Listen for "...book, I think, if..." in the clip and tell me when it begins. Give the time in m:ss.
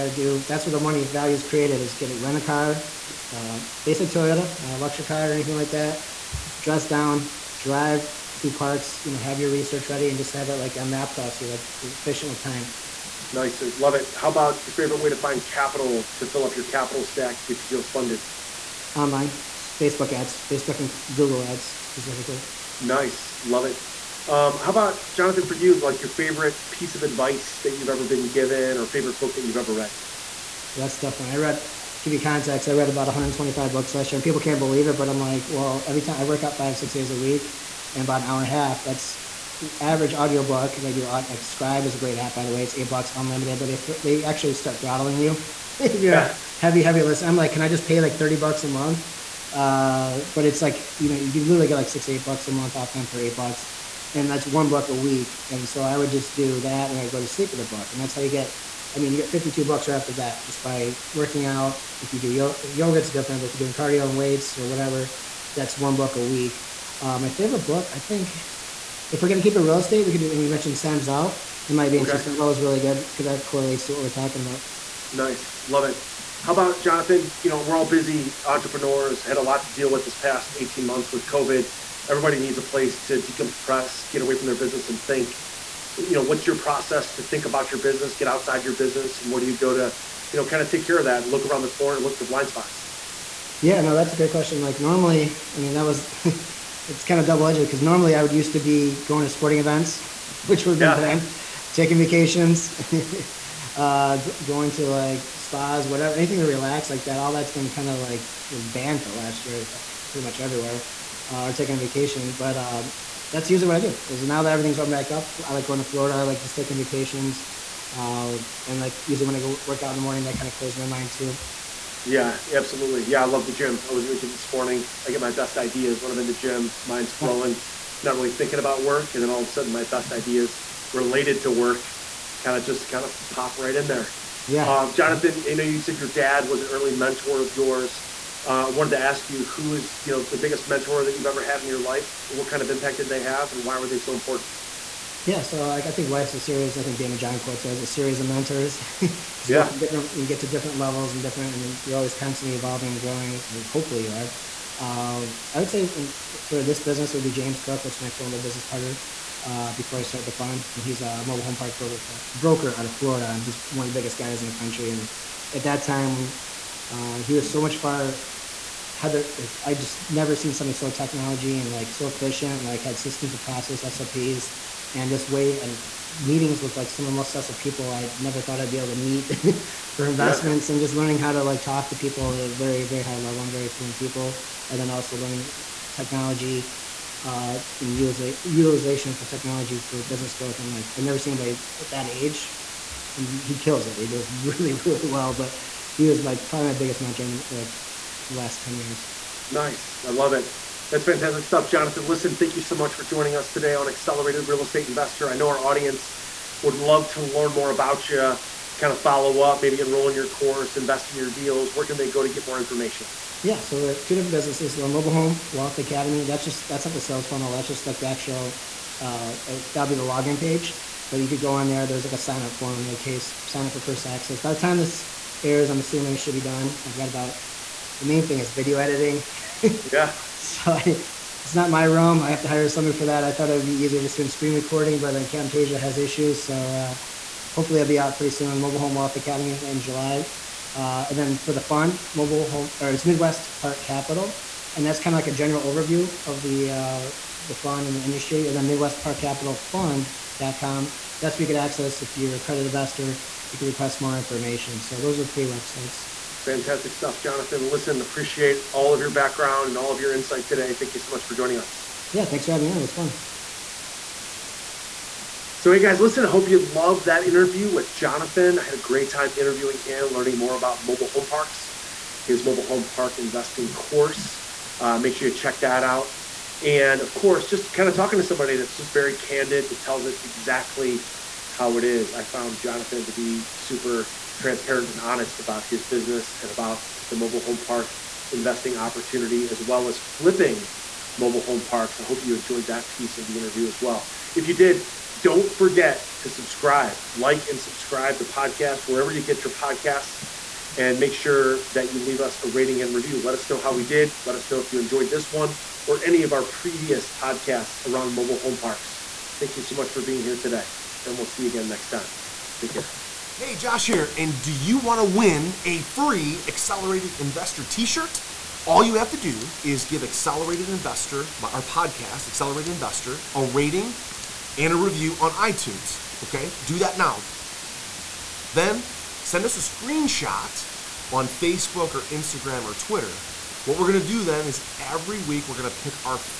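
1:07.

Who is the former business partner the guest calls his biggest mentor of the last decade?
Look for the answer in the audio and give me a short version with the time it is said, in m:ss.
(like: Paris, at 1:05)
James Cook, at 2:37.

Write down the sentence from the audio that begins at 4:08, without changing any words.
And then Midwest Park Capital Fund.com.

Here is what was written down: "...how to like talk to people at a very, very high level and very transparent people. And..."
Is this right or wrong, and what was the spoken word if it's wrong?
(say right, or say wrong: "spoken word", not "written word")
wrong: "fluent", not "transparent".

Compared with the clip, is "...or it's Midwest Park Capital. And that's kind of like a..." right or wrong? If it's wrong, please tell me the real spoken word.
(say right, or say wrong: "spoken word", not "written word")
right.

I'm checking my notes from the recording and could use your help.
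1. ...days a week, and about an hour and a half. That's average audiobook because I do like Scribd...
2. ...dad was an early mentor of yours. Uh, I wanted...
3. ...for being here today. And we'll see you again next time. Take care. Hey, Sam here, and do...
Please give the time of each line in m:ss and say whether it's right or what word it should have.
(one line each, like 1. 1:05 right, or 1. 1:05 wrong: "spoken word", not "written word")
1. 0:36 right
2. 2:16 right
3. 5:09 wrong: "Josh", not "Sam".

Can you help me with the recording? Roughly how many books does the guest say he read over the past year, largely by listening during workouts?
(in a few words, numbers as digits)
125.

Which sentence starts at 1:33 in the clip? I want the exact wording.
Yeah, no, that's a great question.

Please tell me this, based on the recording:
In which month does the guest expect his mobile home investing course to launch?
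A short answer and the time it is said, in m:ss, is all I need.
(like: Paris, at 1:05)
July, at 3:59.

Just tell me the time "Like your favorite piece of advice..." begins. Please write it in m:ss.
0:25.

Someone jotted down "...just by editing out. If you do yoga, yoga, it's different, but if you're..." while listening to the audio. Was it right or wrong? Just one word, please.
wrong.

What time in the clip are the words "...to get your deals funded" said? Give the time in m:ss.
0:17.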